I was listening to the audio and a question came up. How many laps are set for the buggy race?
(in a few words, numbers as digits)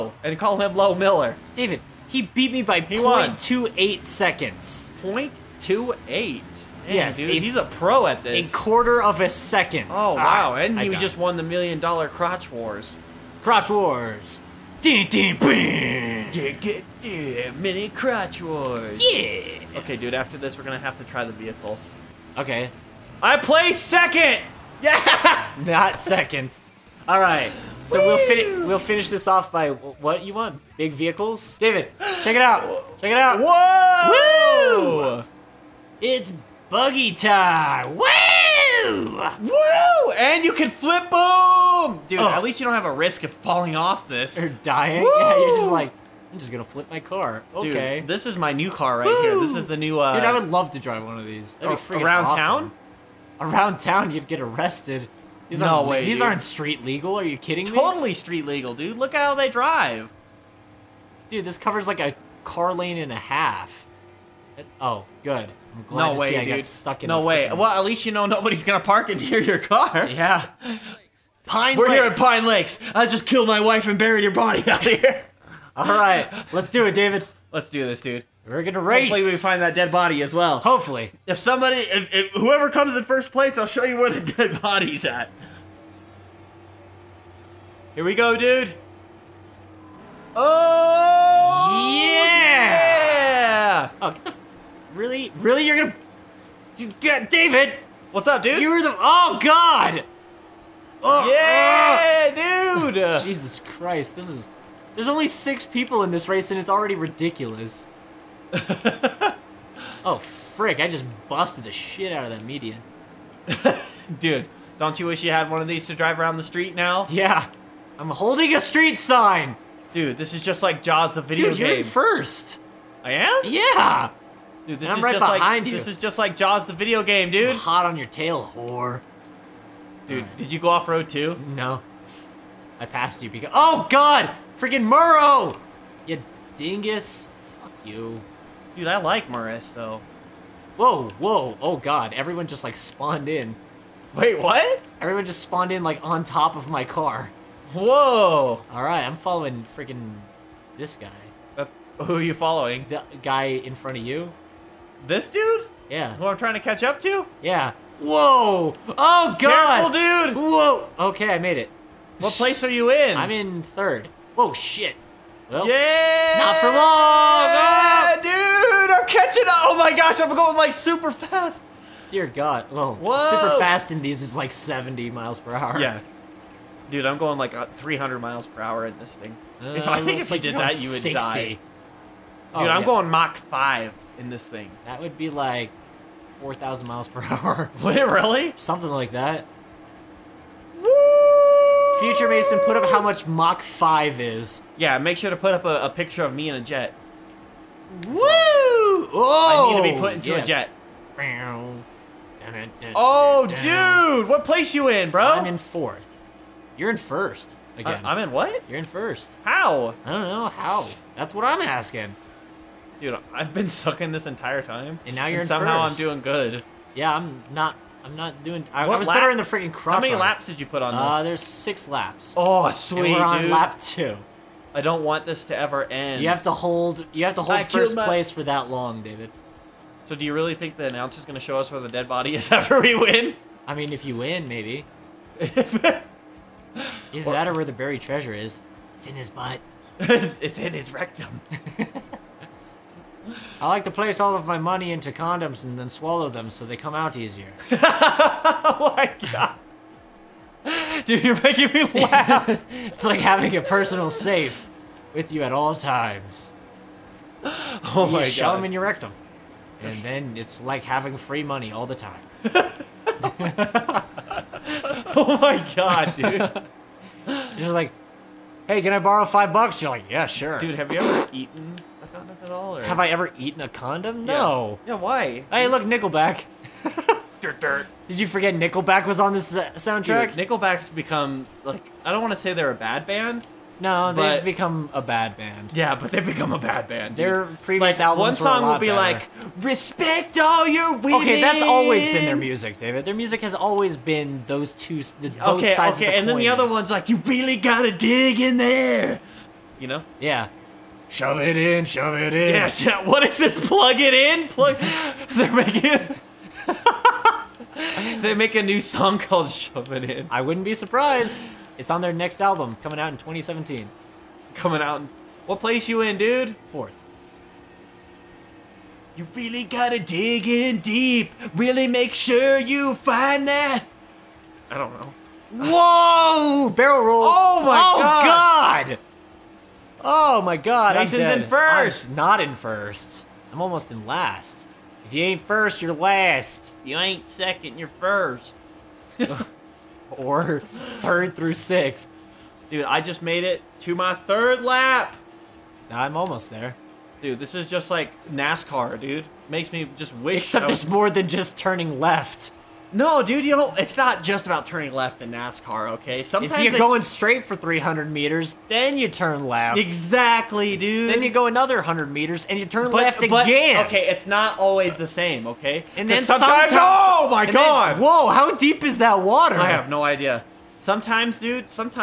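6.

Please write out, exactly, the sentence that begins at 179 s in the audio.
Uh, if, I think if like you did that, you would 60.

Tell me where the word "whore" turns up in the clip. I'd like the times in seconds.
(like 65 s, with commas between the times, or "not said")
128 s.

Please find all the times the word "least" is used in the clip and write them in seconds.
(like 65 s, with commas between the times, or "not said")
42 s, 67 s.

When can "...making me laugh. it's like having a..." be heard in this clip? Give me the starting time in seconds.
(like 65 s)
251 s.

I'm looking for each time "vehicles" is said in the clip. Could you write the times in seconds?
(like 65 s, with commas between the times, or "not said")
21 s, 30 s.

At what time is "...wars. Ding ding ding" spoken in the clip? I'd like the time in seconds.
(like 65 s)
13 s.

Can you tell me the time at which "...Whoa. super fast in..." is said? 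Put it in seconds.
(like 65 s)
172 s.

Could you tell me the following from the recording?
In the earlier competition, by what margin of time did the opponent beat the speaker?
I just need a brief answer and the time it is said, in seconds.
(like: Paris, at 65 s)
0.28 seconds, at 2 s.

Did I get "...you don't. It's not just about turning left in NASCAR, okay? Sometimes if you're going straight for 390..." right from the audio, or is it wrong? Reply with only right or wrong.
wrong.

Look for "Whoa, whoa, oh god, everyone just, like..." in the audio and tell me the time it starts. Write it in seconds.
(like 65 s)
140 s.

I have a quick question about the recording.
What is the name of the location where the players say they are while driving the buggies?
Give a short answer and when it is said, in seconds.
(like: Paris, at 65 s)
Pine Lakes, at 72 s.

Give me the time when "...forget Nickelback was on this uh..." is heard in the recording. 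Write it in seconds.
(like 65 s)
278 s.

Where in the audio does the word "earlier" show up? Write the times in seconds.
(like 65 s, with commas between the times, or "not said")
not said.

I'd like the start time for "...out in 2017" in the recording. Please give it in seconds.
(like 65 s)
312 s.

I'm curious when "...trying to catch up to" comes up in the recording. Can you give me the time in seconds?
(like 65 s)
156 s.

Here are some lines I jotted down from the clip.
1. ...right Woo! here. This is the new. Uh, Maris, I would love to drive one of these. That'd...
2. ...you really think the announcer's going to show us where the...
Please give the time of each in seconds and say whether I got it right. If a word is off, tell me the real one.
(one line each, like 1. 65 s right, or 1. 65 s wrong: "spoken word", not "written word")
1. 48 s wrong: "Dude", not "Maris"
2. 230 s right.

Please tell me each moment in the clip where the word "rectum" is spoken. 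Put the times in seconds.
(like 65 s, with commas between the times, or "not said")
240 s, 258 s.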